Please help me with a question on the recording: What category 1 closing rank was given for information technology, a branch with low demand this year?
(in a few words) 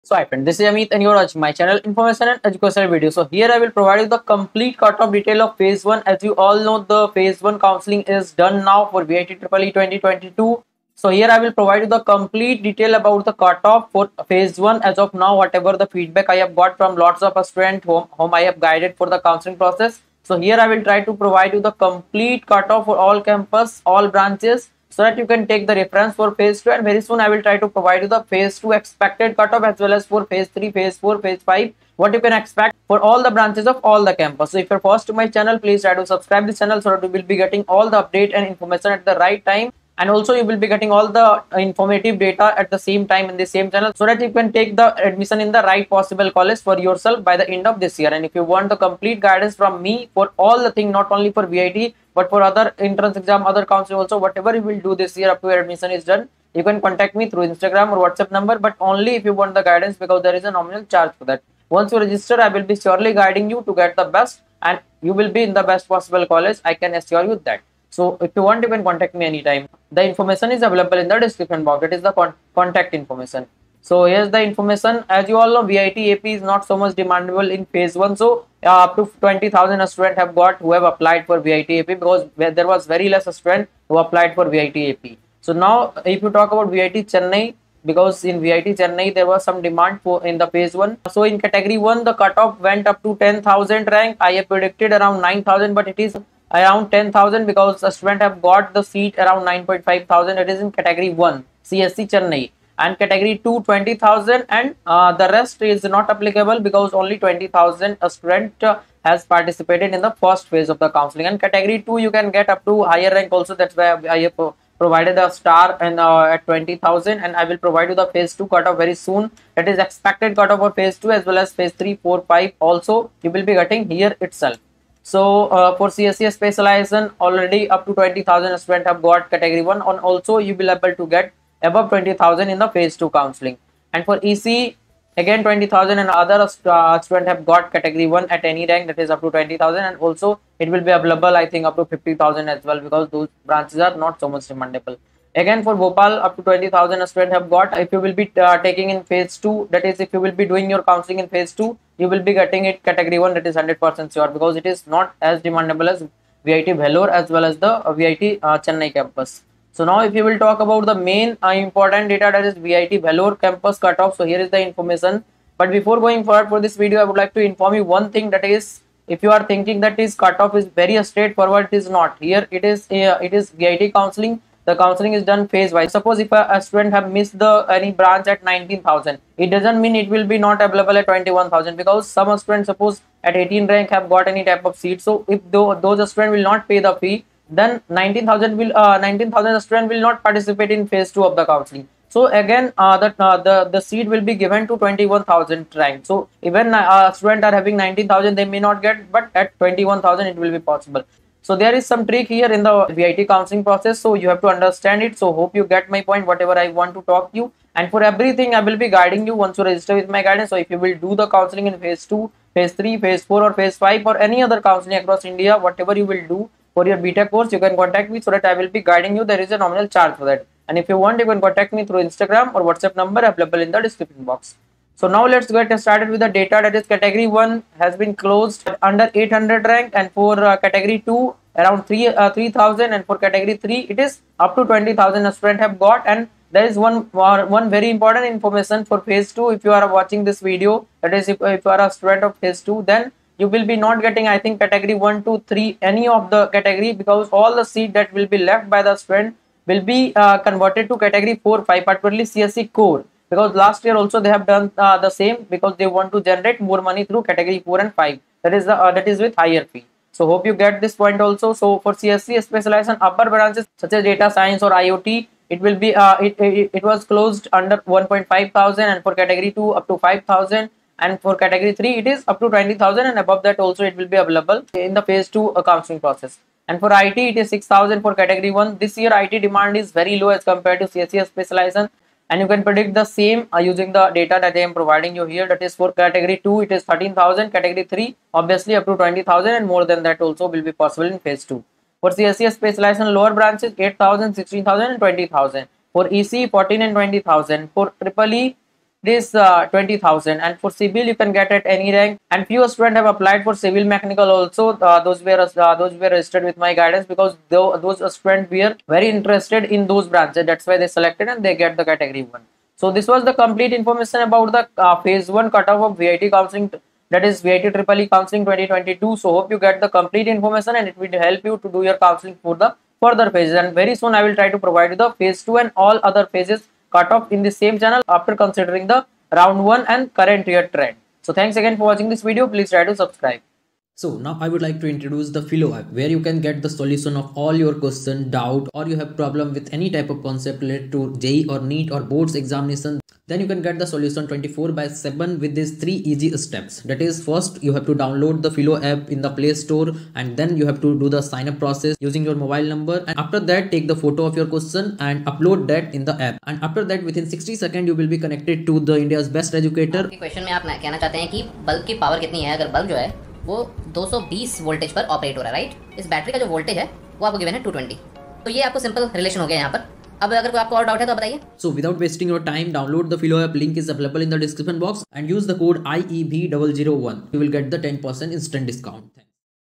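6000.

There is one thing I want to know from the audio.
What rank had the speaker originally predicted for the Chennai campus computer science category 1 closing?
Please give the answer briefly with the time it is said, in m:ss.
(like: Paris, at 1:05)
9000, at 1:34.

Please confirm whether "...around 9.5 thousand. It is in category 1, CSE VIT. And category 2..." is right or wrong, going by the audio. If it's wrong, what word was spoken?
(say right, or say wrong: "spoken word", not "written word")
wrong: "Chennai", not "VIT".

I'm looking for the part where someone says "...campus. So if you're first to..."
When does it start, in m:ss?
0:34.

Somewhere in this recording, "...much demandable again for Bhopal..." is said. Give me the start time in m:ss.
2:24.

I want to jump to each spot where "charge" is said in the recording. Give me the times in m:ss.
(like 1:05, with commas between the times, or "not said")
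1:00, 3:39.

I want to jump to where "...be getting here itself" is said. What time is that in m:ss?
2:03.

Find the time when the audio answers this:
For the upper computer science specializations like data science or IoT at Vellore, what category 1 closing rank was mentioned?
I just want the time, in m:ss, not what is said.
4:26.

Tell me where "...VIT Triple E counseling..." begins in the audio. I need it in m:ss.
5:17.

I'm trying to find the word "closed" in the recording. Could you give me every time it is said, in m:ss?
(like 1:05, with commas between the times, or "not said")
3:48, 4:27.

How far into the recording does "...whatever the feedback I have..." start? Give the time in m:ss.
0:15.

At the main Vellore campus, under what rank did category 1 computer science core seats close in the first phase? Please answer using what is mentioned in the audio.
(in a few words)
800.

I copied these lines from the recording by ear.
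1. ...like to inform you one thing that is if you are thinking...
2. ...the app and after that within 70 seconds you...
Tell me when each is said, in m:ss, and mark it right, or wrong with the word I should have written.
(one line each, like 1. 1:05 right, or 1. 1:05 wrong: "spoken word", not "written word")
1. 2:47 right
2. 5:56 wrong: "60", not "70".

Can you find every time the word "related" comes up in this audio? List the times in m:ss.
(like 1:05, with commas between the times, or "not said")
5:40.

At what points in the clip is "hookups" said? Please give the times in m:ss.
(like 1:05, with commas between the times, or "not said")
not said.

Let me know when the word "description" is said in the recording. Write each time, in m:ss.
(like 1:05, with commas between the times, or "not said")
1:11, 3:43.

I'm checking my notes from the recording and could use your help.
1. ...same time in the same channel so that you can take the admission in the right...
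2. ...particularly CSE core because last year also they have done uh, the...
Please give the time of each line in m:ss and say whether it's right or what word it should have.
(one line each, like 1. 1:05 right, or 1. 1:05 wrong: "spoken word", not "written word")
1. 0:42 right
2. 4:11 right.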